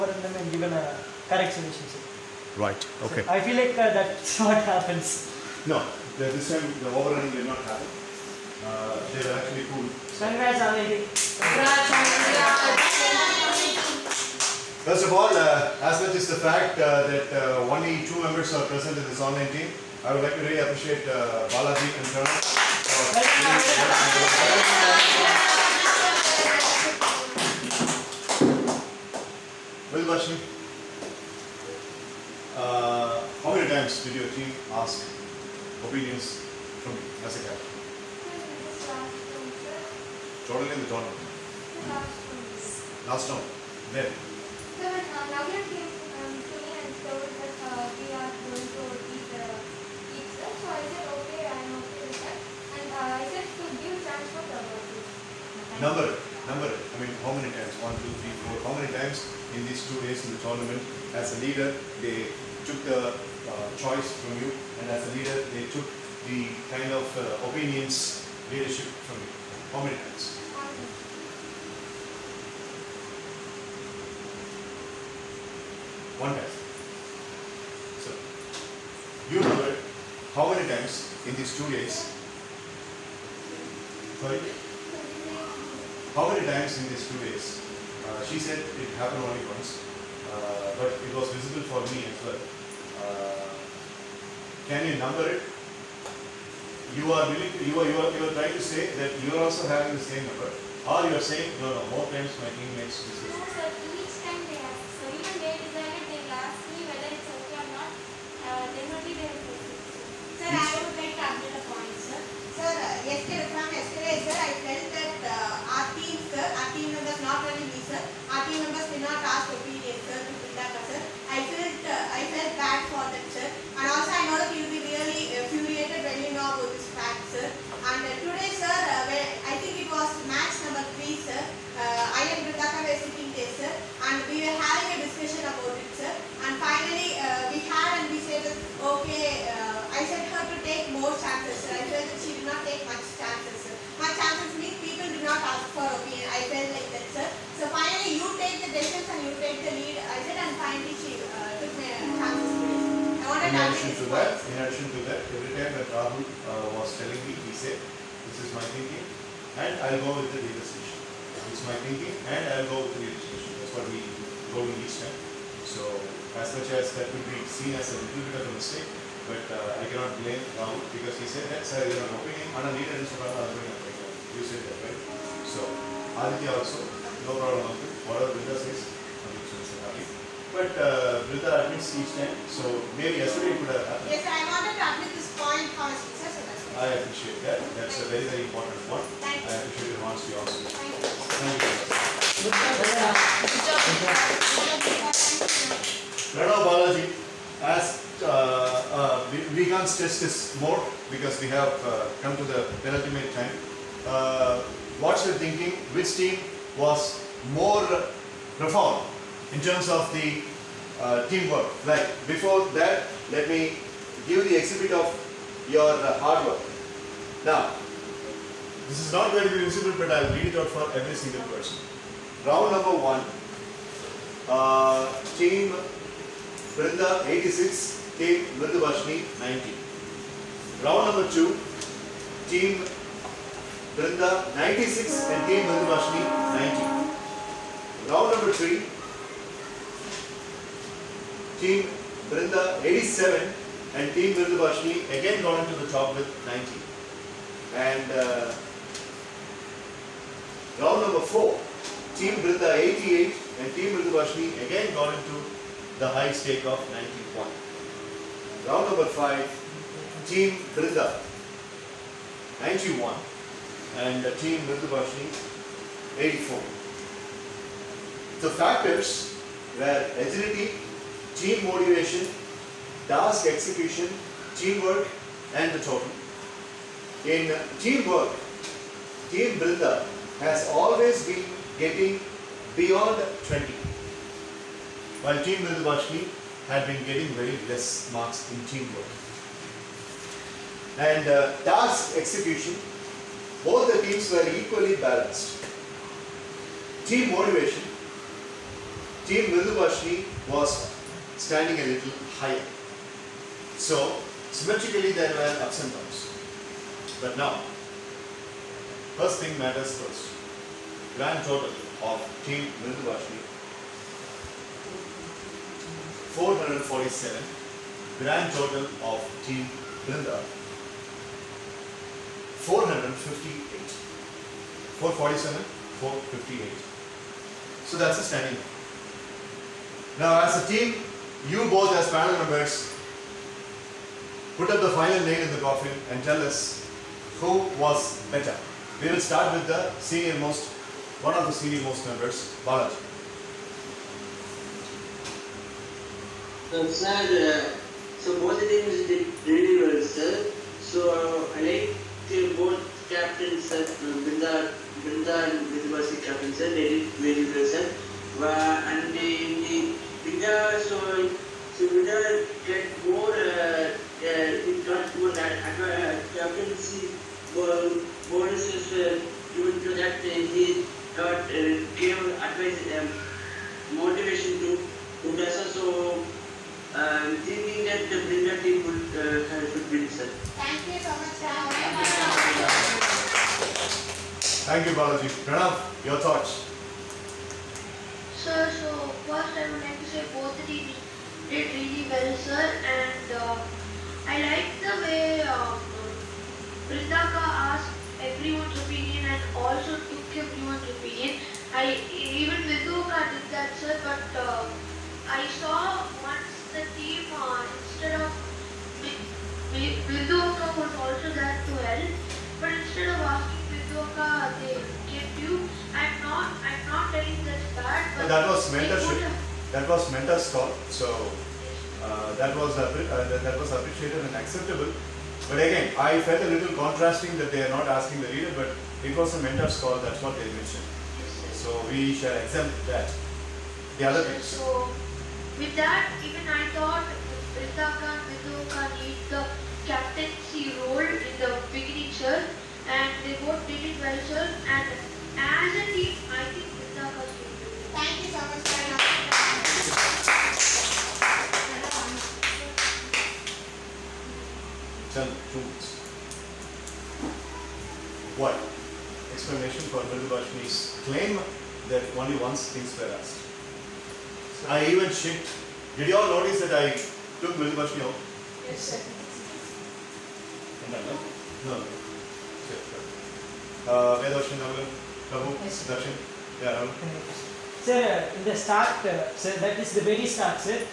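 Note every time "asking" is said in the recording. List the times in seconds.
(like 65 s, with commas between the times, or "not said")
413 s, 427 s.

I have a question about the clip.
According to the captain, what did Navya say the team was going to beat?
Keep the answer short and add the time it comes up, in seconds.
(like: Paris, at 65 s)
the pizza, at 49 s.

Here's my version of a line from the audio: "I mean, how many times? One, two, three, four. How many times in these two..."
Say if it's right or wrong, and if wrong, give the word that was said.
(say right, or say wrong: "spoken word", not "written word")
right.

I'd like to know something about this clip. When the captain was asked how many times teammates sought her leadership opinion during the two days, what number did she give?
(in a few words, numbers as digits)
1.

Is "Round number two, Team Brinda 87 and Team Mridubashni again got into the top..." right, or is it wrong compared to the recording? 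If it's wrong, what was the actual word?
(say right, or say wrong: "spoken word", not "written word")
wrong: "three", not "two".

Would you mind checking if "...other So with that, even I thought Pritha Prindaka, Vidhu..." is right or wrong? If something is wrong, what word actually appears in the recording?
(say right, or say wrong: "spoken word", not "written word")
wrong: "Khan", not "Prindaka".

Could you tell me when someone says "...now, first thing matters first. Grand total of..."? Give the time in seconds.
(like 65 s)
307 s.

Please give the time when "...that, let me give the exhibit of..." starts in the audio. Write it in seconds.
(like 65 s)
212 s.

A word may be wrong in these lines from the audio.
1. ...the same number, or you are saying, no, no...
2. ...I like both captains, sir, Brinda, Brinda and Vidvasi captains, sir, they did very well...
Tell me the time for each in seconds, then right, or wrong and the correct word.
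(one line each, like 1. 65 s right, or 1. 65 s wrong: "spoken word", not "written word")
1. 99 s right
2. 351 s right.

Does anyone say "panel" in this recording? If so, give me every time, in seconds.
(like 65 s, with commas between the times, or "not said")
332 s.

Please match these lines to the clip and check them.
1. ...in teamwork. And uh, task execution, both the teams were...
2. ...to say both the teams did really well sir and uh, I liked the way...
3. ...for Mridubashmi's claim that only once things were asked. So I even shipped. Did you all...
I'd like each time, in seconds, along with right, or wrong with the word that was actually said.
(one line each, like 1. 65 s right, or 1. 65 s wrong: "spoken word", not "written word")
1. 288 s right
2. 389 s right
3. 459 s right.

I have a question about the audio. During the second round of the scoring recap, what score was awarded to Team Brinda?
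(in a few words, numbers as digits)
96.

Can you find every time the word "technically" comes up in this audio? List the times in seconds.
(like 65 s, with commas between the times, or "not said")
not said.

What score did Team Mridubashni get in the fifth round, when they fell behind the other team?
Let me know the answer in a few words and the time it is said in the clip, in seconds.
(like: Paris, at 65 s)
84, at 266 s.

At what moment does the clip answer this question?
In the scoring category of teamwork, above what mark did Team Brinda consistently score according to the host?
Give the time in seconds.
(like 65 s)
283 s.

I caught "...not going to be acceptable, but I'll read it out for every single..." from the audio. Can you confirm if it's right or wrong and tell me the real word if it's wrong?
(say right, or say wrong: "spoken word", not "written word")
wrong: "visible", not "acceptable".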